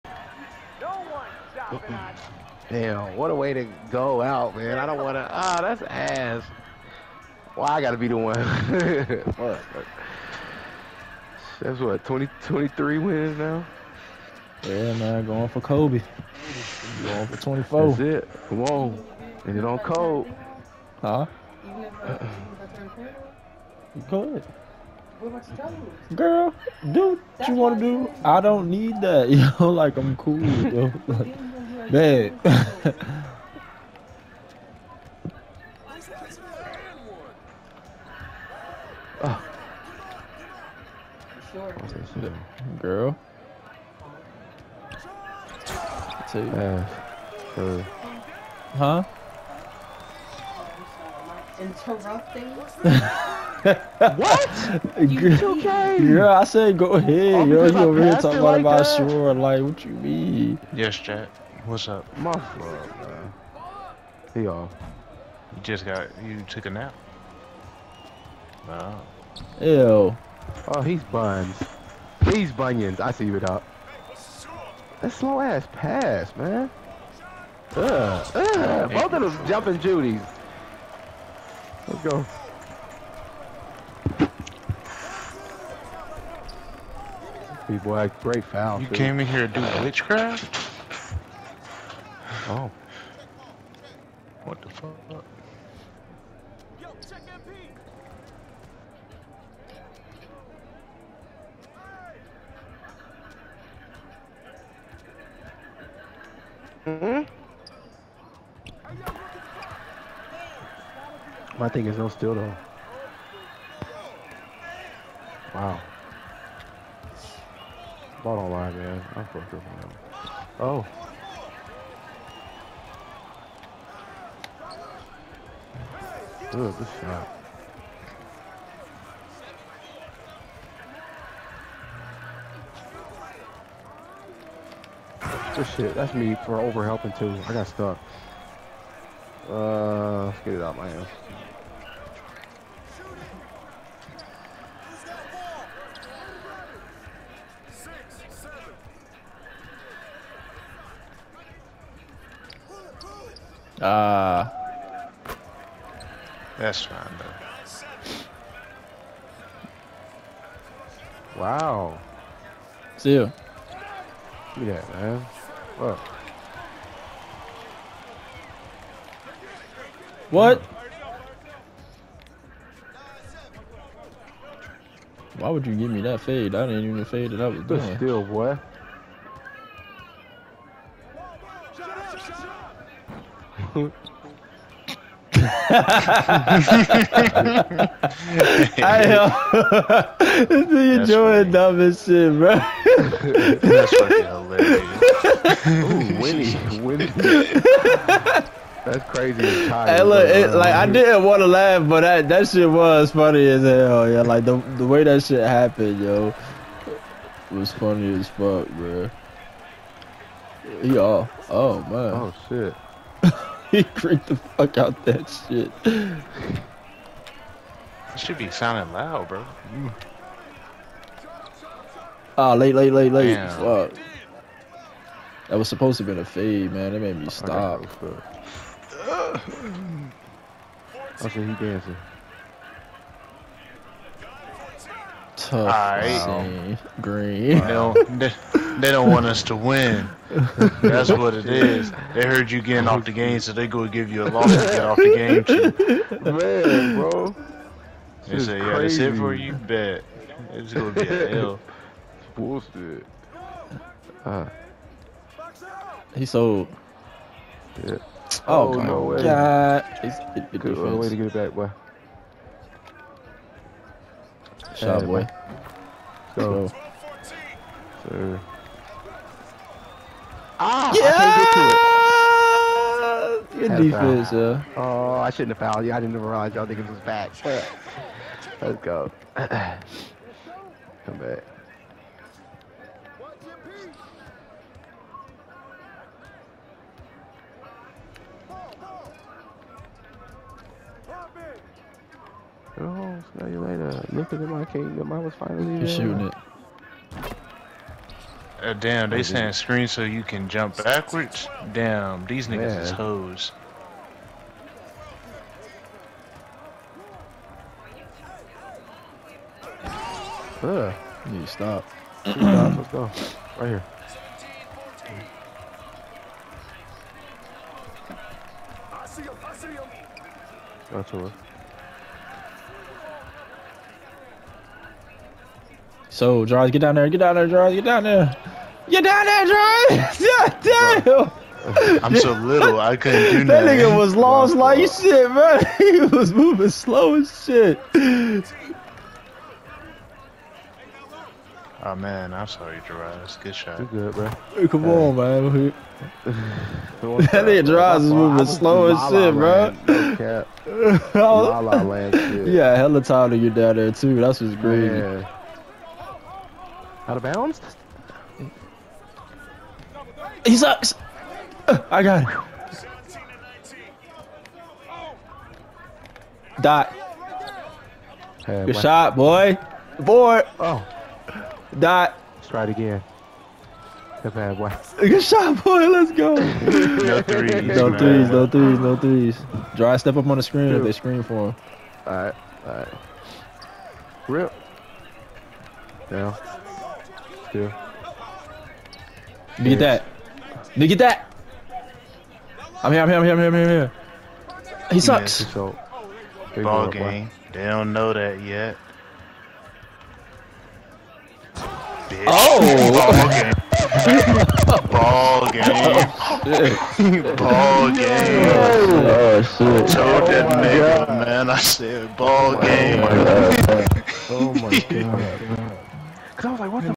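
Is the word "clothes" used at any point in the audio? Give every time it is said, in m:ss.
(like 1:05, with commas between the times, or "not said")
not said.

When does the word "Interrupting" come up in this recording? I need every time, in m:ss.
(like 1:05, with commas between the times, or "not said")
0:51.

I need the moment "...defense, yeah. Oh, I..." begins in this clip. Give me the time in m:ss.
4:33.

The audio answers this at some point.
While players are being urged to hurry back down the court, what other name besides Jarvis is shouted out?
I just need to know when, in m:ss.
5:29.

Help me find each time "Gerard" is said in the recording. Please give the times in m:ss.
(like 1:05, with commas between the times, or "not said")
5:42, 5:47.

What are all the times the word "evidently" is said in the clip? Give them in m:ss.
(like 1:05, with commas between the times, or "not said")
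not said.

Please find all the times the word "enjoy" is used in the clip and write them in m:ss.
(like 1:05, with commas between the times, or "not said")
not said.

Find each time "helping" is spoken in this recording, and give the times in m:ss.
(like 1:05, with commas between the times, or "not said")
2:16.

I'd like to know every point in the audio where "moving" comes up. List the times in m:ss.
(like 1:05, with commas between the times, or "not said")
5:36, 5:48.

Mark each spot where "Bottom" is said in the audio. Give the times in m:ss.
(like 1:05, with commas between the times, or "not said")
1:58.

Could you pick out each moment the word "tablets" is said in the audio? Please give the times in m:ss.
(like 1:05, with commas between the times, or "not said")
not said.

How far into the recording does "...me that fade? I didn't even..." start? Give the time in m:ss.
2:55.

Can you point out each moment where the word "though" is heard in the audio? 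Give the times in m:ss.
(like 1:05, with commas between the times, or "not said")
0:30, 1:52, 2:41.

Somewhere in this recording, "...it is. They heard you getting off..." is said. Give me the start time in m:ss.
4:01.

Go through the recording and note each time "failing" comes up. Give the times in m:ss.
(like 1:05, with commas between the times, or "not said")
not said.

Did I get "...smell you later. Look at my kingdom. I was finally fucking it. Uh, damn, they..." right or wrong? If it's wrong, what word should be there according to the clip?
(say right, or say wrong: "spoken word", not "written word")
wrong: "shooting", not "fucking".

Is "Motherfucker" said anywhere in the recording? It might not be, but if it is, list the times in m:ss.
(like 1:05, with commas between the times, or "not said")
1:02.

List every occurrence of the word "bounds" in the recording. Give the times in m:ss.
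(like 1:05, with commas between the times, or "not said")
5:57.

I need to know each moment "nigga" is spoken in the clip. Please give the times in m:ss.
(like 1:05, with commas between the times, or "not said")
5:02, 5:33, 5:47, 6:30, 6:50.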